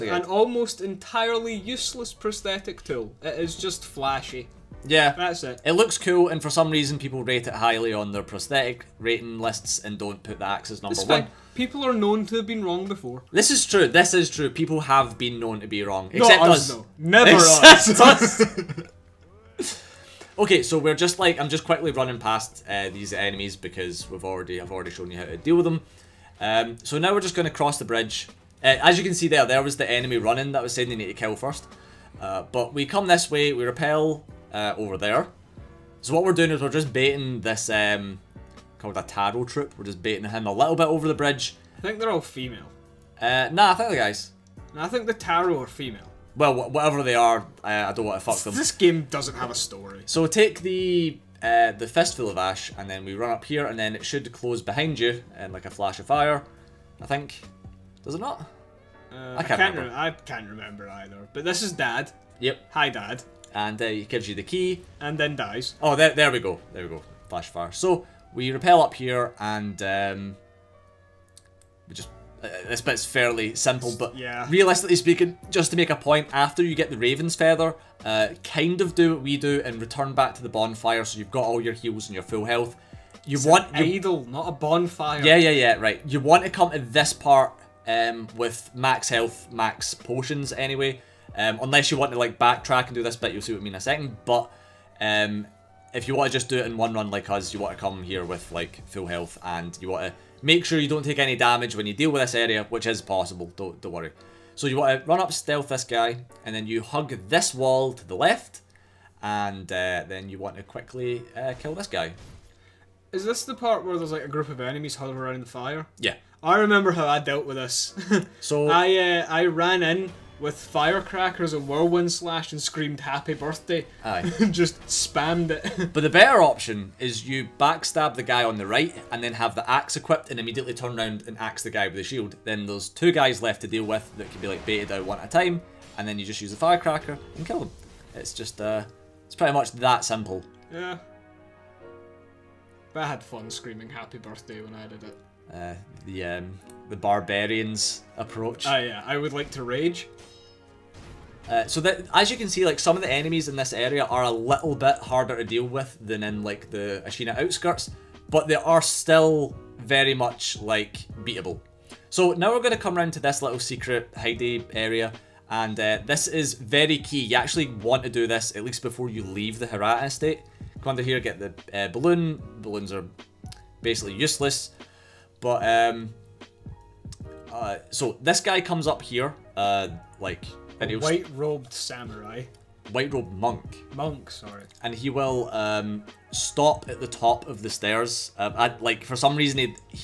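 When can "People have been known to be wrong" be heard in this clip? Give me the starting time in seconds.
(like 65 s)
14 s.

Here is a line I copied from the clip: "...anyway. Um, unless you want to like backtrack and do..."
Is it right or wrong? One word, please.
right.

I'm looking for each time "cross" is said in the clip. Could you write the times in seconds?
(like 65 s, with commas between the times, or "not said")
27 s.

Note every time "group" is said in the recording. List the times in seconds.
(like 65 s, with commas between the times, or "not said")
114 s.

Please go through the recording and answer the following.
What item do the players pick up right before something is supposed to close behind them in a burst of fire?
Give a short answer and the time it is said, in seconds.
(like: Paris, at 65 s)
Fistful of ash, at 51 s.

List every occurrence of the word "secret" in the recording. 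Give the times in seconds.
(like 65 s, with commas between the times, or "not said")
163 s.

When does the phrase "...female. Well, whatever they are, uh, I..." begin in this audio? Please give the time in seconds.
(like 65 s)
45 s.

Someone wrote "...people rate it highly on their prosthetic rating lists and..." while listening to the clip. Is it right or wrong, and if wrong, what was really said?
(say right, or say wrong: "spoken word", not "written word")
right.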